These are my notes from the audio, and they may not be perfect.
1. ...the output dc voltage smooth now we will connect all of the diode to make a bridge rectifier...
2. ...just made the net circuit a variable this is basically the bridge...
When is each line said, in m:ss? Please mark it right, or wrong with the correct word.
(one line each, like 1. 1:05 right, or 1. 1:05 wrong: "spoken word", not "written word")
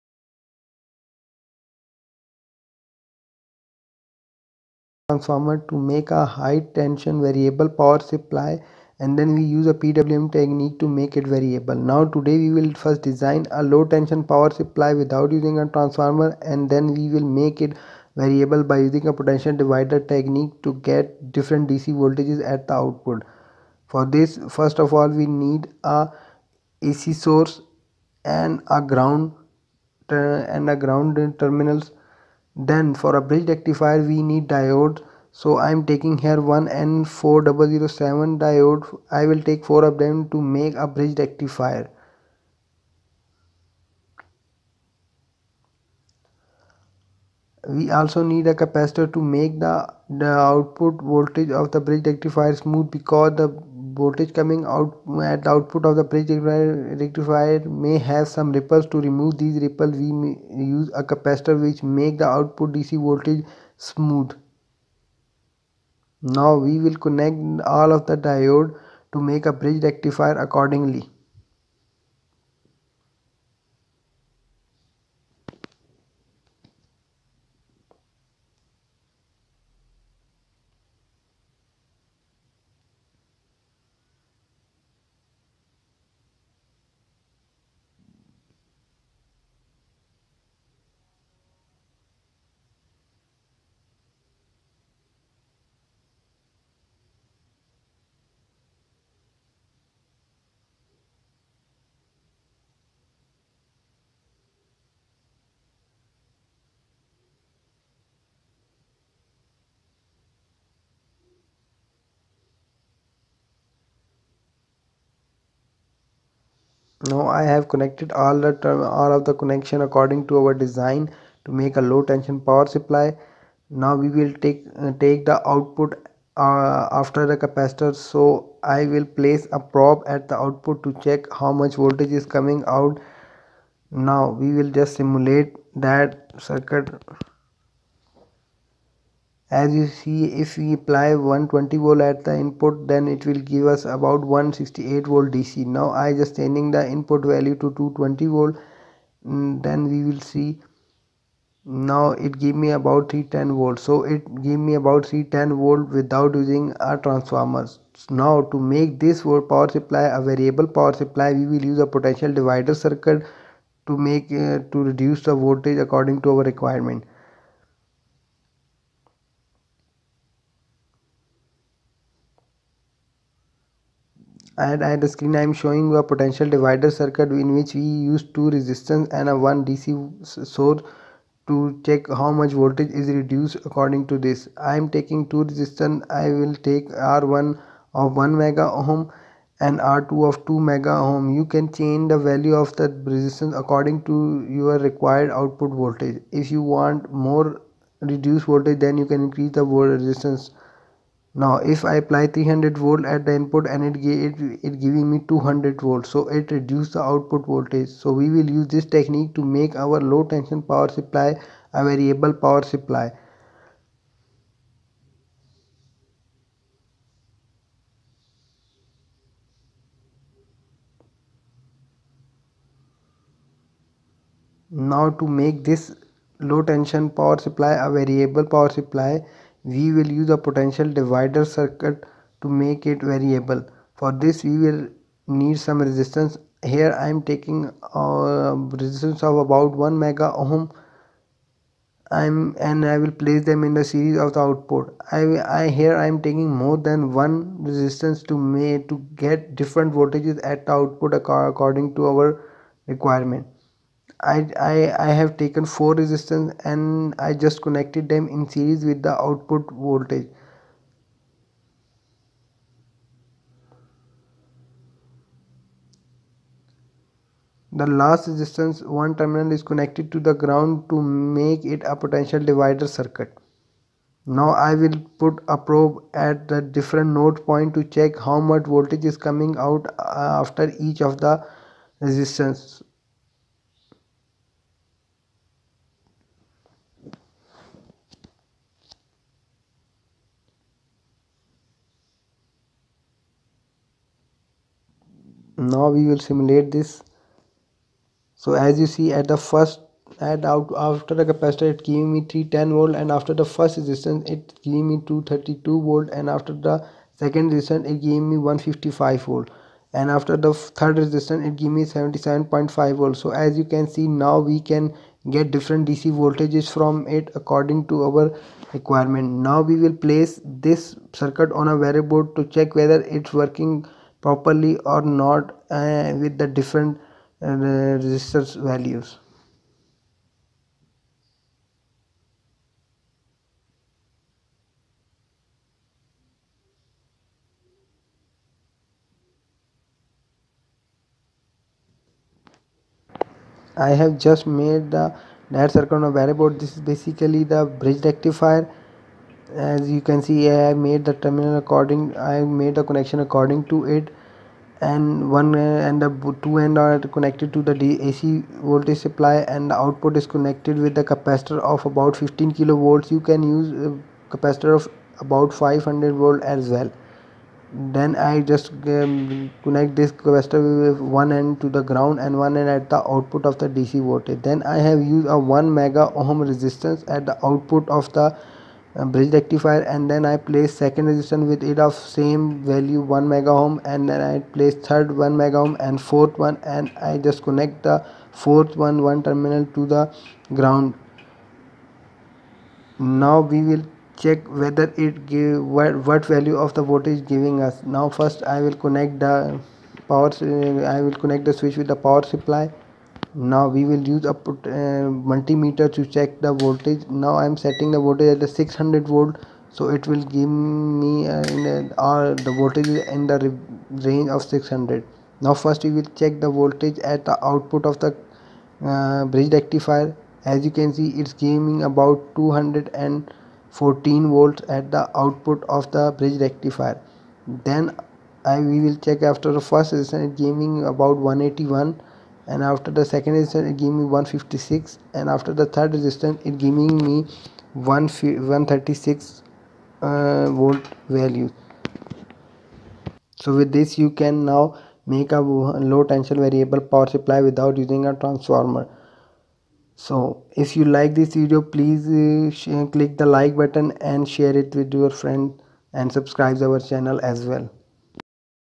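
1. 1:02 right
2. 5:44 right.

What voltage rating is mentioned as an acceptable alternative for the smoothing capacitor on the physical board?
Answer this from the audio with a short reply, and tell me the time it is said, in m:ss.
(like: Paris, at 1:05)
500 volts, at 6:05.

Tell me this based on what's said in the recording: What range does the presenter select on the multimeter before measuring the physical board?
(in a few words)
600 volts.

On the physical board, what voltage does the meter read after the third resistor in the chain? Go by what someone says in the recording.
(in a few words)
136 volts.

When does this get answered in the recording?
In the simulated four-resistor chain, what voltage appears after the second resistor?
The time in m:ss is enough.
5:08.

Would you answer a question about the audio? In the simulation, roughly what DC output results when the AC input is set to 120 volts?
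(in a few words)
168 volts.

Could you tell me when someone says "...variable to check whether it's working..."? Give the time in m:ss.
5:21.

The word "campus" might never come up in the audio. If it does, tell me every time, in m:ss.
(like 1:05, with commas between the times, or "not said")
not said.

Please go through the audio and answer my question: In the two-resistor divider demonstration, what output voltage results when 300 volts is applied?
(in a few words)
200 volts.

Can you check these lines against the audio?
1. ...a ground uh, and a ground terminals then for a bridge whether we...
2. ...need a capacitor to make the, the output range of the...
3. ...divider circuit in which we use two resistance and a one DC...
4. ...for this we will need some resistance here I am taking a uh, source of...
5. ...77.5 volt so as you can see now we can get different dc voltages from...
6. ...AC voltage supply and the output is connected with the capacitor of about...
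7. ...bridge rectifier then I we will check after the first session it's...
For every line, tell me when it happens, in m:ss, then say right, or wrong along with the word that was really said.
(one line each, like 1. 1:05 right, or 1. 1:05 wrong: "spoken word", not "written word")
1. 0:28 wrong: "rectifier", not "whether"
2. 0:48 wrong: "voltage", not "range"
3. 2:56 right
4. 3:53 wrong: "resistance", not "source"
5. 5:11 right
6. 5:58 right
7. 7:06 right.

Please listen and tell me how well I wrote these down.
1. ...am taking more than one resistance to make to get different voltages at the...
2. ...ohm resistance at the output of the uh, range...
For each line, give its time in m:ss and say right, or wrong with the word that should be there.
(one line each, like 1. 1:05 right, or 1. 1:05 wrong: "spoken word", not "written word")
1. 4:06 right
2. 6:16 wrong: "bridge", not "range".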